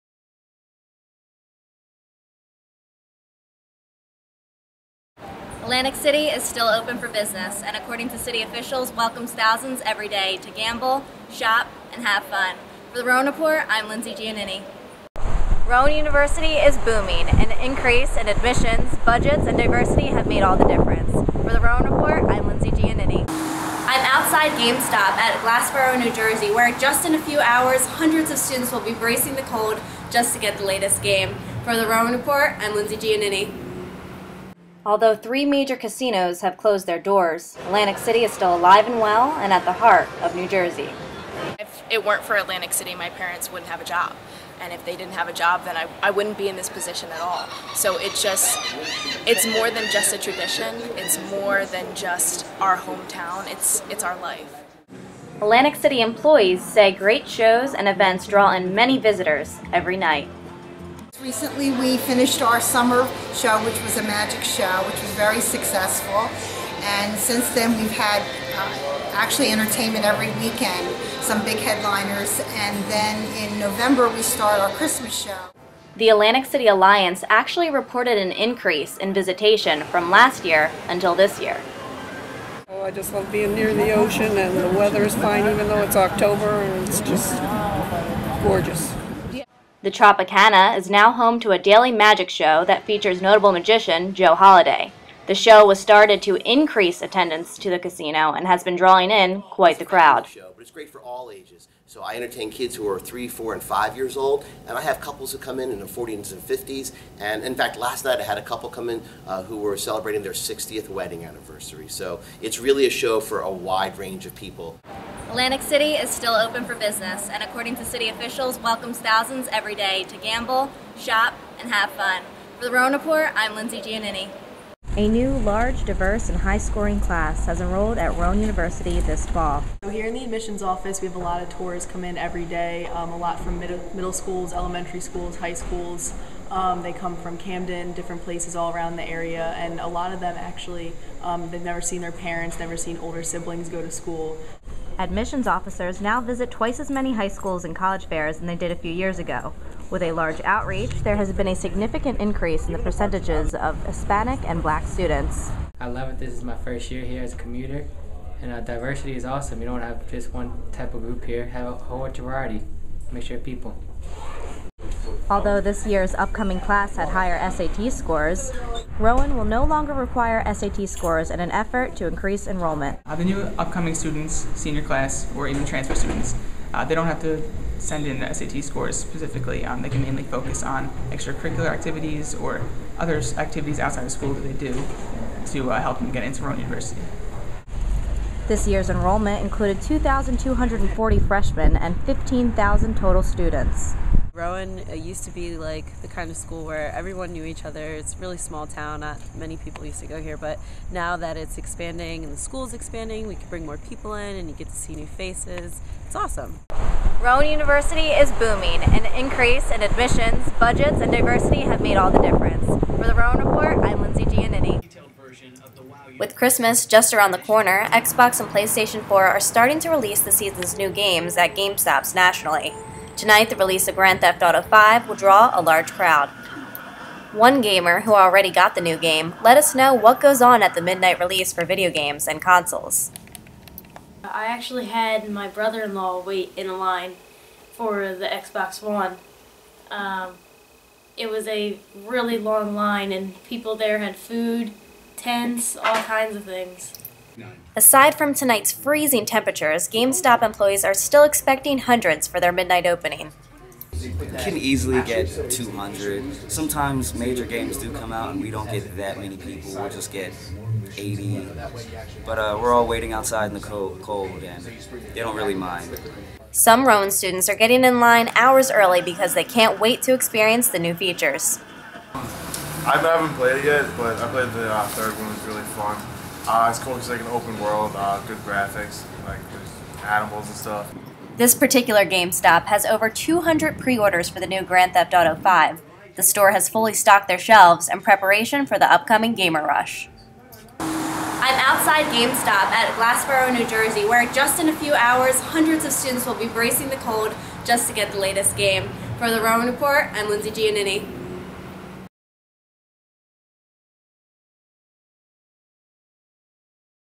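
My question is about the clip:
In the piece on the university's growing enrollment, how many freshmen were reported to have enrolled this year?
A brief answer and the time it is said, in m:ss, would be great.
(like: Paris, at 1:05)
2,240, at 3:09.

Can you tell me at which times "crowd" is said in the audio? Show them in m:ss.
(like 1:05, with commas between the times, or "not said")
1:39, 3:45.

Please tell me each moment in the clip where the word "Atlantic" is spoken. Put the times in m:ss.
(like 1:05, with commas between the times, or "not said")
0:05, 0:37, 0:42, 0:55, 1:16, 1:55.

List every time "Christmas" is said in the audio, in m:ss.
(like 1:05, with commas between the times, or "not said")
1:14, 3:36.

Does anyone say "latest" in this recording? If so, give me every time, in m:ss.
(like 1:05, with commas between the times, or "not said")
0:30, 4:58.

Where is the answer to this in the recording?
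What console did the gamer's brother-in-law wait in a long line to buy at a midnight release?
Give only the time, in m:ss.
3:58.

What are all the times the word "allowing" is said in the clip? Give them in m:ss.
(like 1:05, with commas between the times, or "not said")
not said.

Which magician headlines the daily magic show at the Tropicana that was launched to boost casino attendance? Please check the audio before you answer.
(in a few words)
Joe Holiday.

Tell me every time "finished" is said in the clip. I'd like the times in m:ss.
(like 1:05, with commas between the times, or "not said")
1:01.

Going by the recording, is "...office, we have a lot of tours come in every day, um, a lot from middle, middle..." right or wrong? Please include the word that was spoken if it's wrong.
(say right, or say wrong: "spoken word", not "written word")
right.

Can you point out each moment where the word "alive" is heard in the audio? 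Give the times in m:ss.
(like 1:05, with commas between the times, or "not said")
0:38.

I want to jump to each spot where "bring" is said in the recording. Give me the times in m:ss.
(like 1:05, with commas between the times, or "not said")
3:23.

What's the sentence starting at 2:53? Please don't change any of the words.
Uh, the new upcoming students, senior class, or even transfer students, uh, they don't have to send in SAT scores specifically.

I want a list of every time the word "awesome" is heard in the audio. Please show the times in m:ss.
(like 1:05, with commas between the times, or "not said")
2:39, 3:26.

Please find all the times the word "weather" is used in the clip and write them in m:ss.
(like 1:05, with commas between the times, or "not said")
1:24.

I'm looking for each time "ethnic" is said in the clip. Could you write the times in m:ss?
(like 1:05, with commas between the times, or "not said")
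not said.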